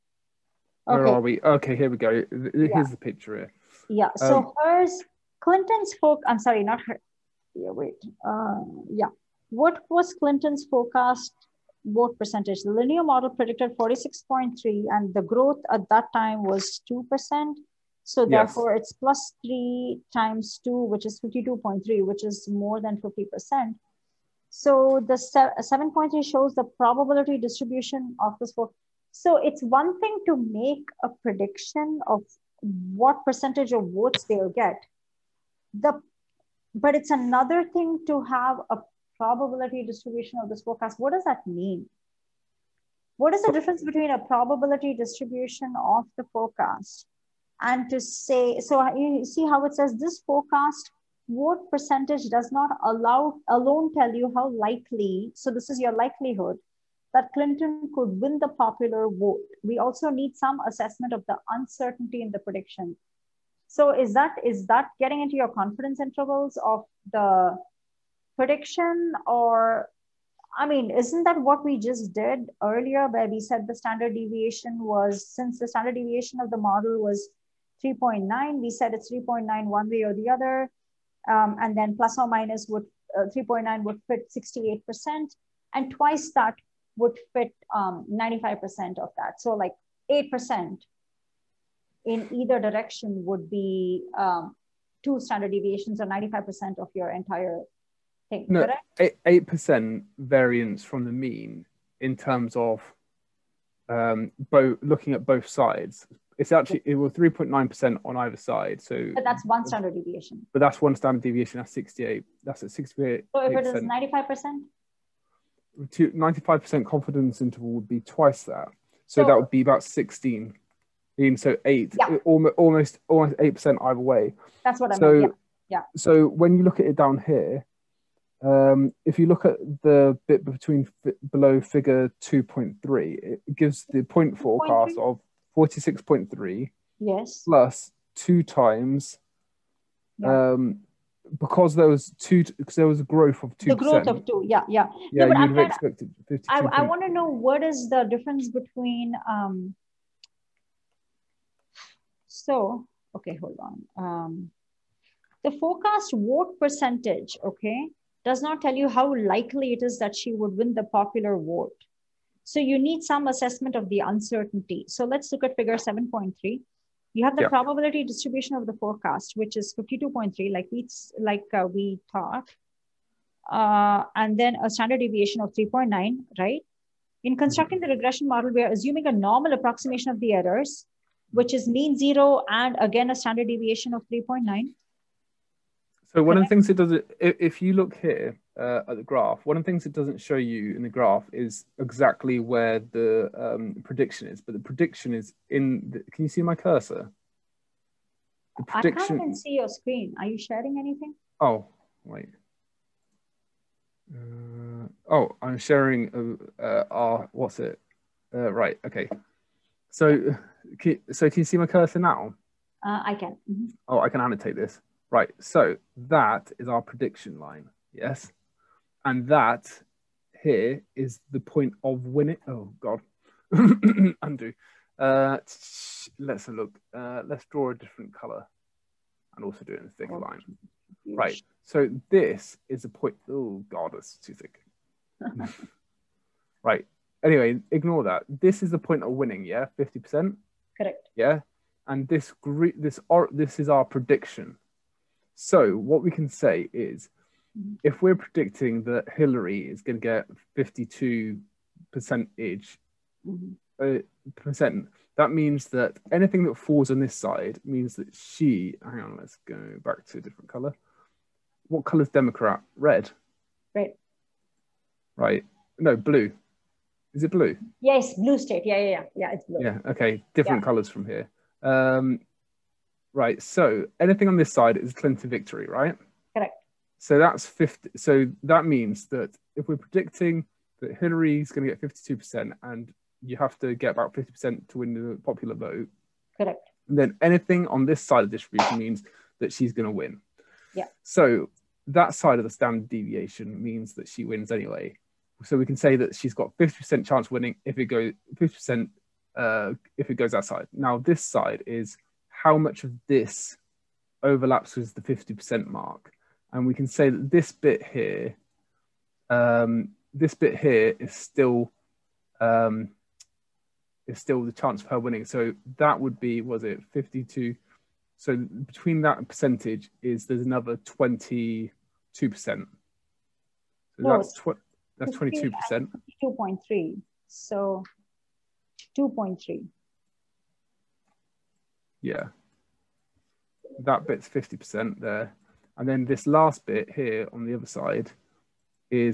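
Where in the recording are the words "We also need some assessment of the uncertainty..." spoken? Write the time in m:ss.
0:59.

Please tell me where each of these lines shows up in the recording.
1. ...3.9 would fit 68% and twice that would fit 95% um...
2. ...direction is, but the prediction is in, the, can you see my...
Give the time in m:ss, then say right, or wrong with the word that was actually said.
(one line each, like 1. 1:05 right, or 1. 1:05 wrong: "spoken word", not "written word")
1. 1:23 right
2. 3:13 wrong: "prediction", not "direction".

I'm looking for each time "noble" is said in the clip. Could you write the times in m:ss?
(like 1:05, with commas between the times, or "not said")
not said.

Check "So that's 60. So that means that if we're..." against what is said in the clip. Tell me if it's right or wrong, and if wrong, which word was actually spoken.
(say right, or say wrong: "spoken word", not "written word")
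wrong: "50", not "60".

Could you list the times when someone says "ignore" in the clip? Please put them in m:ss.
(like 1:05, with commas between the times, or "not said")
3:57.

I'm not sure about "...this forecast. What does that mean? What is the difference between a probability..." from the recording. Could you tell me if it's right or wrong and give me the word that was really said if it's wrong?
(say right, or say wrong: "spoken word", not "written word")
right.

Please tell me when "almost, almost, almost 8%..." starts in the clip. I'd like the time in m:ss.
2:02.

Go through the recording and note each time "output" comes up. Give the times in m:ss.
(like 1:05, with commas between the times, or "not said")
not said.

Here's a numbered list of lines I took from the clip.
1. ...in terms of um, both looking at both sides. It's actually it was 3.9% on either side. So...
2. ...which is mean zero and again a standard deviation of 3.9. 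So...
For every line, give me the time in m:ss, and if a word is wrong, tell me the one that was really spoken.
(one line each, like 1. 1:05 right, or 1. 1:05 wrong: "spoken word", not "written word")
1. 1:42 right
2. 3:01 right.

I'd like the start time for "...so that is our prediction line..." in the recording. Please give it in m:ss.
3:35.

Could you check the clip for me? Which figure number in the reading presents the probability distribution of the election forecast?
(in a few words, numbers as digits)
7.3.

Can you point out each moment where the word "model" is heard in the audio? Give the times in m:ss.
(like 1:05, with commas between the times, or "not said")
0:13, 1:16, 2:58.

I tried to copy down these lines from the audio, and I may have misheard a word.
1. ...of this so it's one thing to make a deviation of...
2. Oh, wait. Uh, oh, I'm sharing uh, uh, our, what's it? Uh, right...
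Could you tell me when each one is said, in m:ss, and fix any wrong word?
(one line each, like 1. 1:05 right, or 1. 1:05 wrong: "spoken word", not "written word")
1. 0:28 wrong: "prediction", not "deviation"
2. 3:21 right.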